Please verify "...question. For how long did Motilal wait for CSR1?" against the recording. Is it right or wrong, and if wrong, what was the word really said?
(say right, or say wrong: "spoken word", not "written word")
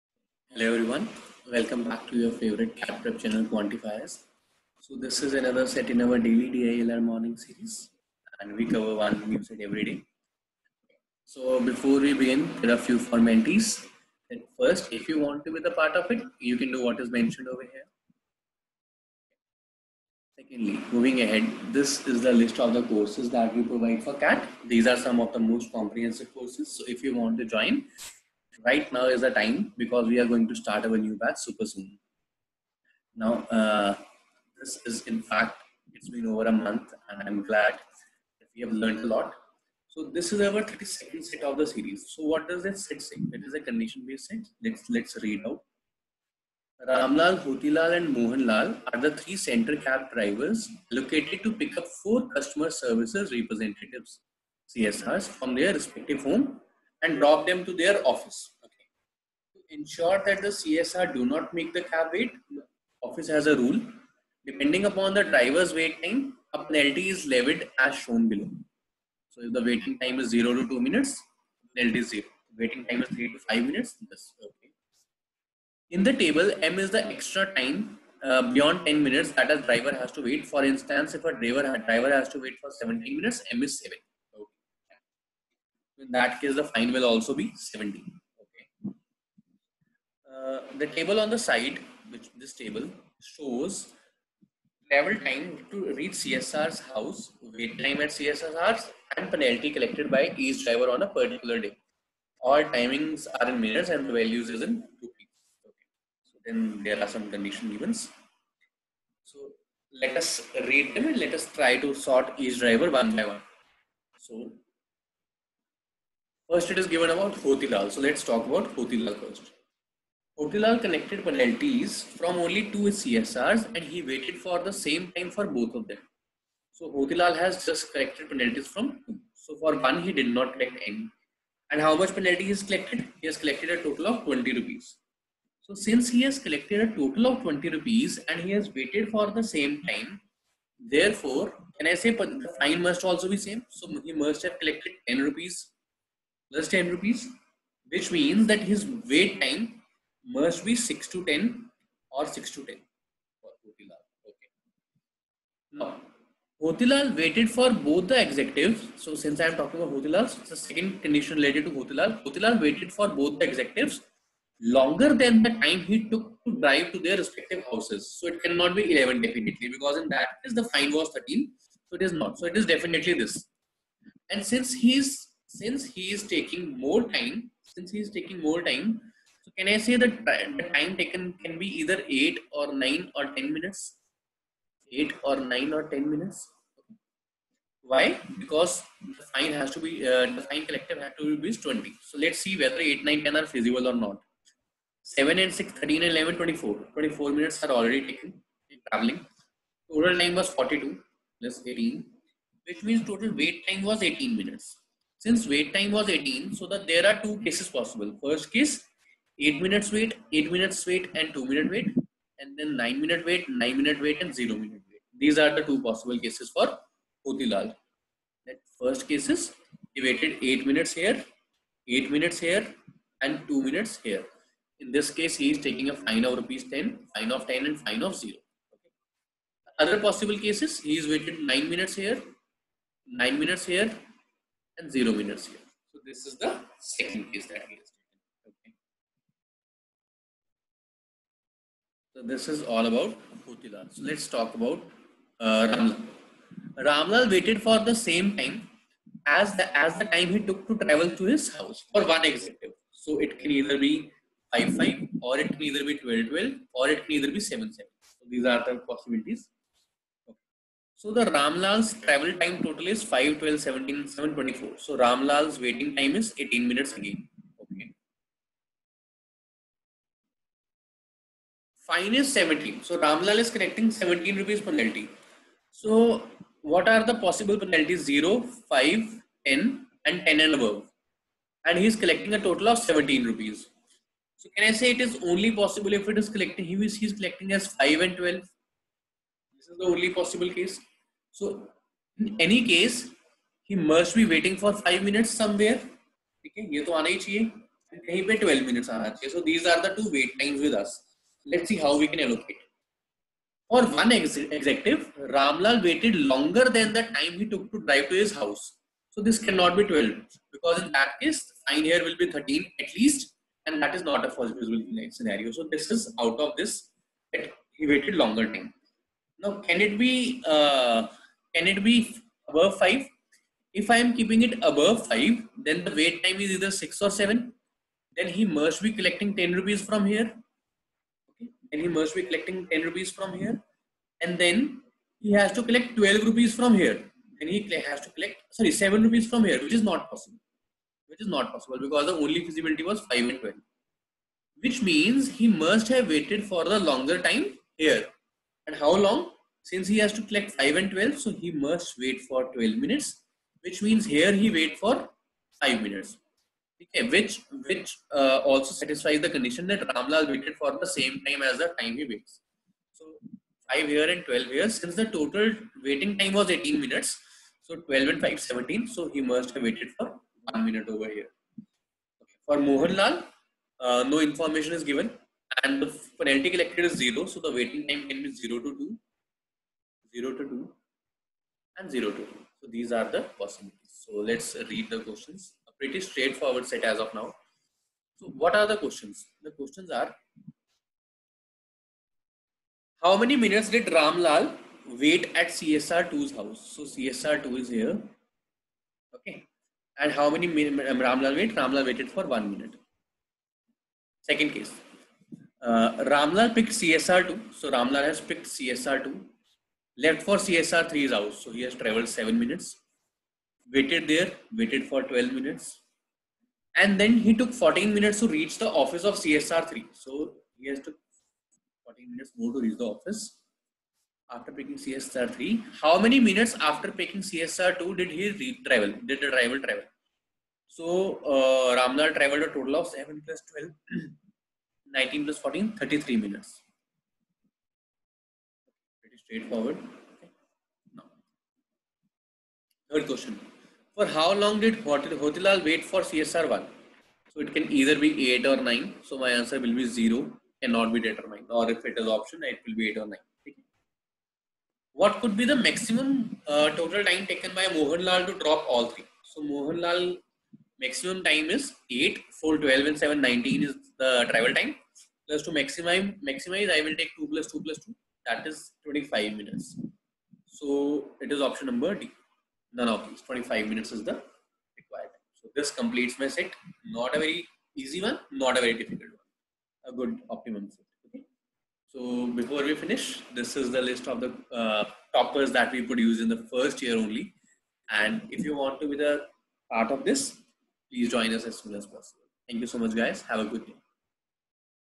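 wrong: "Hotilal", not "Motilal".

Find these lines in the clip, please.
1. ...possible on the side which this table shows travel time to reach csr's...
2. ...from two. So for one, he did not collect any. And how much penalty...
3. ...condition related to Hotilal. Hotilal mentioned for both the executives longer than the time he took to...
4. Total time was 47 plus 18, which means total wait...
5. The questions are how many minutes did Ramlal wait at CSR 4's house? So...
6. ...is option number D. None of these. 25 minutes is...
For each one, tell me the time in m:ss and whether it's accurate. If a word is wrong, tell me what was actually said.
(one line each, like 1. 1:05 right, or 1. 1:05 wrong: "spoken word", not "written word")
1. 1:30 wrong: "table", not "possible"
2. 2:08 right
3. 2:41 wrong: "waited", not "mentioned"
4. 3:19 wrong: "42", not "47"
5. 6:29 wrong: "2", not "4"
6. 7:51 right.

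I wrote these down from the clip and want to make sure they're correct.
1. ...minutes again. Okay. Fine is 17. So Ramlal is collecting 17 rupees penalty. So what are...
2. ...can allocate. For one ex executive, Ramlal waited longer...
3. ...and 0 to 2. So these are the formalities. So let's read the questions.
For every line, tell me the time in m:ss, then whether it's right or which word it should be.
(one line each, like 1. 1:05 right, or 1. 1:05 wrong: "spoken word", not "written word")
1. 4:26 right
2. 5:02 right
3. 6:21 wrong: "possibilities", not "formalities".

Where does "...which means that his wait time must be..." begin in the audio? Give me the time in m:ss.
2:27.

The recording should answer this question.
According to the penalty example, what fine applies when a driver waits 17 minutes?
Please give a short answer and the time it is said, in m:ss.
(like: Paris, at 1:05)
70, at 1:27.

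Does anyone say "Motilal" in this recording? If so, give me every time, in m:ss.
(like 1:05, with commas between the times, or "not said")
3:37, 4:03.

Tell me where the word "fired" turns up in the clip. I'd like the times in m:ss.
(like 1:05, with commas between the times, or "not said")
not said.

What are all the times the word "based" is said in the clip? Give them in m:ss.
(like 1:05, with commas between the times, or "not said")
0:43.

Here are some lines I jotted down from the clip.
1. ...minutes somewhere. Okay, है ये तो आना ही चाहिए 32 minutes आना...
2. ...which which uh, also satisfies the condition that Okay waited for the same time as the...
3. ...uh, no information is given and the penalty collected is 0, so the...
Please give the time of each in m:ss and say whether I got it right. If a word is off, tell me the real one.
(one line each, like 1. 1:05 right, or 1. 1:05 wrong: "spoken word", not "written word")
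1. 4:55 wrong: "12", not "32"
2. 5:57 wrong: "Ramlal", not "Okay"
3. 6:13 right.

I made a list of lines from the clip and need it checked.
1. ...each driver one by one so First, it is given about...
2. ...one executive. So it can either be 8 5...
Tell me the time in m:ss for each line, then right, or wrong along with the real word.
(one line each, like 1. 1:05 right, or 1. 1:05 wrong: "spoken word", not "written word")
1. 1:52 right
2. 4:12 wrong: "5", not "8".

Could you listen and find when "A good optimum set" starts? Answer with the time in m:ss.
7:59.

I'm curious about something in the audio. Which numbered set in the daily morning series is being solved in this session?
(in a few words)
32nd.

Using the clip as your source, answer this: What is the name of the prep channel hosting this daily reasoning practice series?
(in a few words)
Quantifiers.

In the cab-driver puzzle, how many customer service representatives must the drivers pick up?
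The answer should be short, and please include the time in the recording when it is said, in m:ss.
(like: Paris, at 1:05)
4, at 0:52.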